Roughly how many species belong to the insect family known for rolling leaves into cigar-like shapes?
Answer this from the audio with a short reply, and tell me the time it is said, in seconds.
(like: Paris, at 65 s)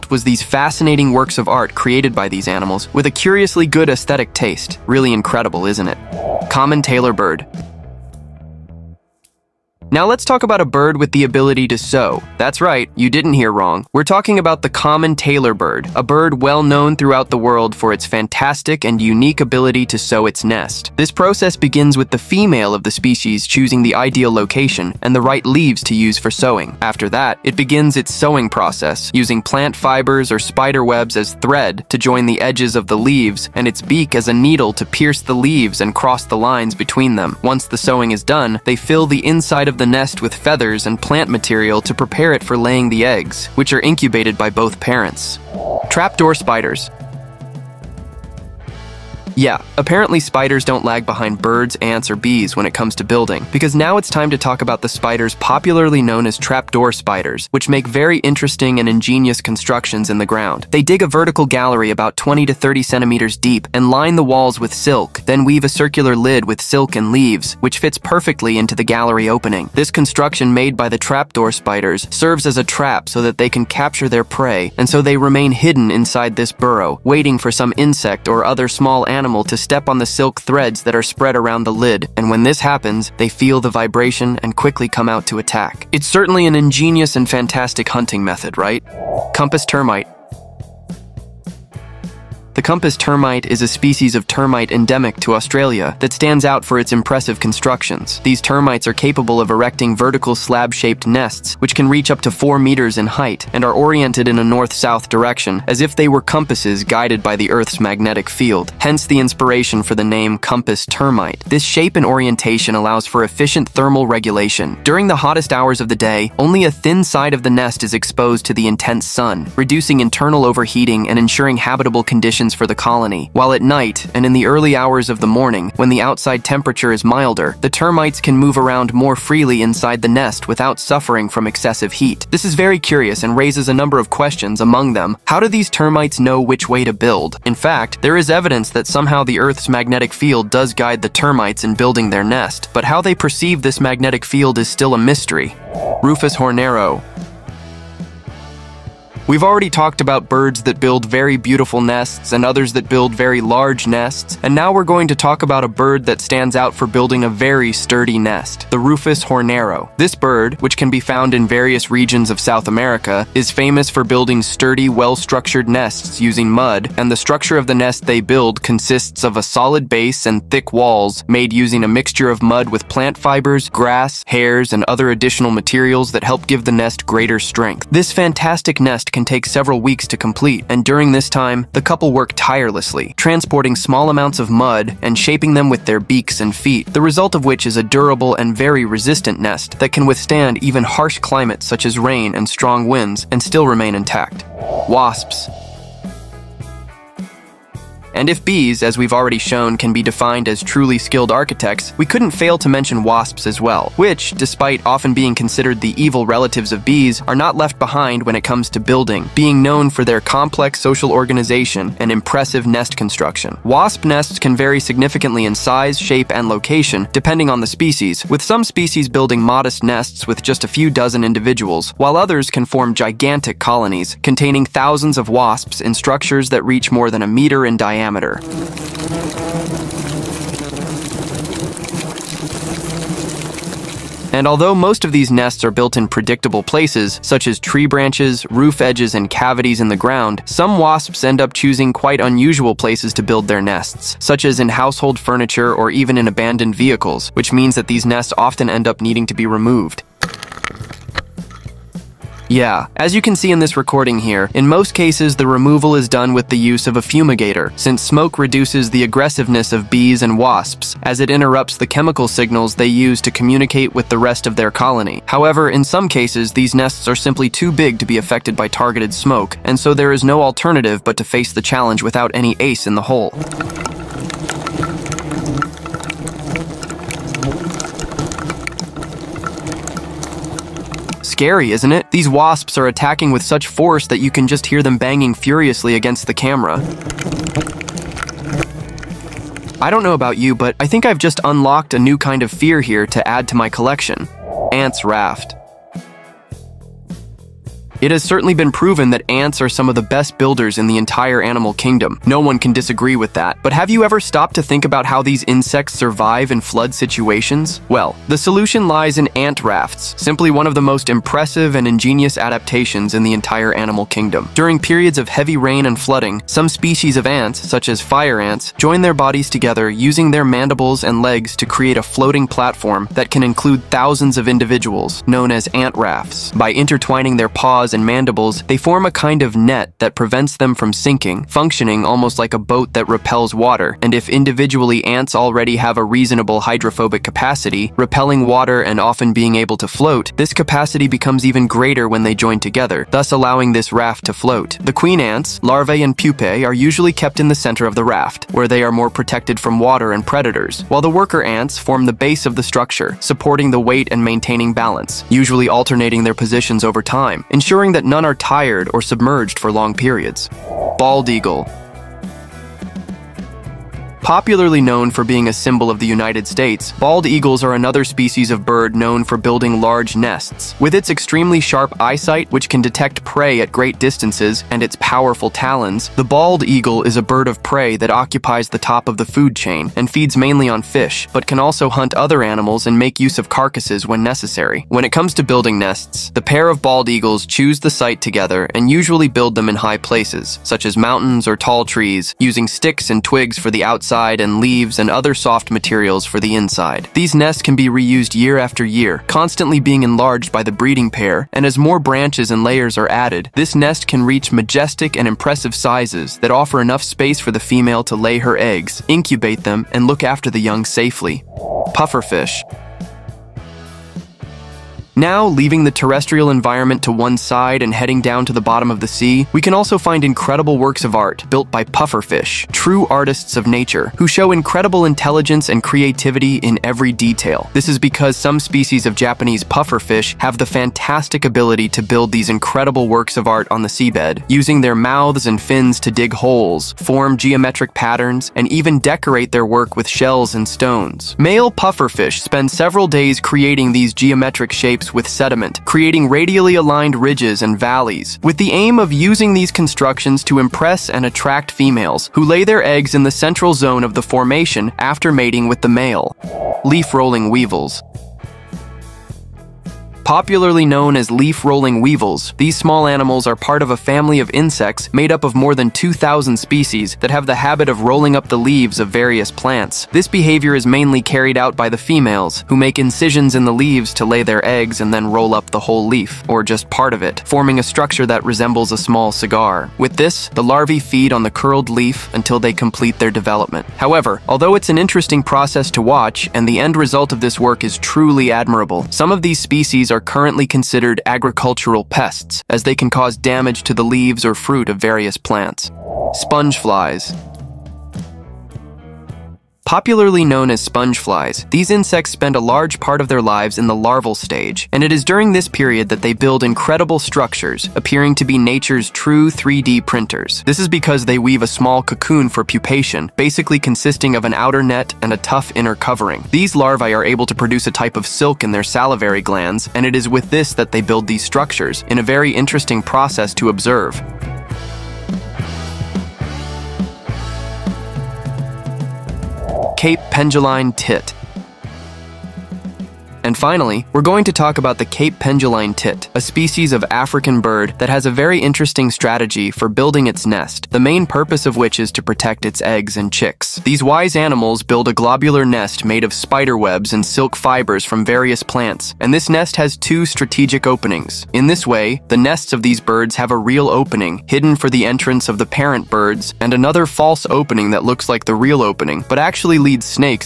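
more than 2,000, at 465 s.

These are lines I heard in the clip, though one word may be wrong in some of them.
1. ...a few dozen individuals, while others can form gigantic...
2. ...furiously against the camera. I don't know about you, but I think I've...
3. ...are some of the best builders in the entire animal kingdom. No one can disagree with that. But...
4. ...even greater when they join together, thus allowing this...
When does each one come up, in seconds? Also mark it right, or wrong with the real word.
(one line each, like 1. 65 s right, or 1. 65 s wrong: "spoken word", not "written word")
1. 220 s right
2. 285 s right
3. 299 s right
4. 341 s right.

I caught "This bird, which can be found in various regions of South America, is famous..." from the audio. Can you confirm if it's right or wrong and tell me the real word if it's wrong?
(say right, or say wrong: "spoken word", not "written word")
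right.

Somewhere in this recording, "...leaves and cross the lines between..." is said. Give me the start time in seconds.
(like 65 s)
35 s.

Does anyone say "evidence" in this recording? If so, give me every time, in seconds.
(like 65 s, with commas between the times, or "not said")
138 s.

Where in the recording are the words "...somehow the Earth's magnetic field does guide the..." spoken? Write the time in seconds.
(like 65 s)
138 s.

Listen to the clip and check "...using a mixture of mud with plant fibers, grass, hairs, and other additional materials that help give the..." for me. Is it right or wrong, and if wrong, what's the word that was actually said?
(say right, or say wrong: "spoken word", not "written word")
right.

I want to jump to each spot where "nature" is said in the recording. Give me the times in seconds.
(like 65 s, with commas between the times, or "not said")
423 s, 508 s.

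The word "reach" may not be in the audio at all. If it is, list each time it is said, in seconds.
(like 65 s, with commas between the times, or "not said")
101 s, 226 s, 404 s.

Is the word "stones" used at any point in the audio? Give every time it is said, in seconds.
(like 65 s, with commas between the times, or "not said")
440 s.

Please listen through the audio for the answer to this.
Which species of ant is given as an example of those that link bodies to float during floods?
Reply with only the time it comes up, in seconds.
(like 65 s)
318 s.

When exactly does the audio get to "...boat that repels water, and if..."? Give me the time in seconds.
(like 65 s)
332 s.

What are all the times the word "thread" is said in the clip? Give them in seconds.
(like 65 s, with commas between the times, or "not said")
31 s, 80 s.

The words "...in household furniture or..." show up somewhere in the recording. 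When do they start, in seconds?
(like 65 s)
244 s.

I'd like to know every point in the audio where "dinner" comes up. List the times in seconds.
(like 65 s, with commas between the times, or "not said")
not said.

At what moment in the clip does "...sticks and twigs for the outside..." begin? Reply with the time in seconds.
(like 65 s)
392 s.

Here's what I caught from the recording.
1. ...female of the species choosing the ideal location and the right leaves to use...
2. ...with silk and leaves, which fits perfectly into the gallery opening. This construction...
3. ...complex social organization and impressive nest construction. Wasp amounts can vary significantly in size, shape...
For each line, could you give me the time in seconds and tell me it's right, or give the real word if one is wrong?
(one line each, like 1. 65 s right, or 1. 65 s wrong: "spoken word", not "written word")
1. 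22 s right
2. 66 s right
3. 210 s wrong: "nests", not "amounts".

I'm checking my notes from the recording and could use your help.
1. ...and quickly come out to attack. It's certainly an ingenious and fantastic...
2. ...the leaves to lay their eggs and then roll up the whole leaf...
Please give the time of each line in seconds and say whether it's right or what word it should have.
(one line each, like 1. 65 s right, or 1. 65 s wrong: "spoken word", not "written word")
1. 84 s right
2. 473 s right.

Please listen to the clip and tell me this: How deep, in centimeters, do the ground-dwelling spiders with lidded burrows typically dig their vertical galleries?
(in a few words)
20 to 30 centimeters.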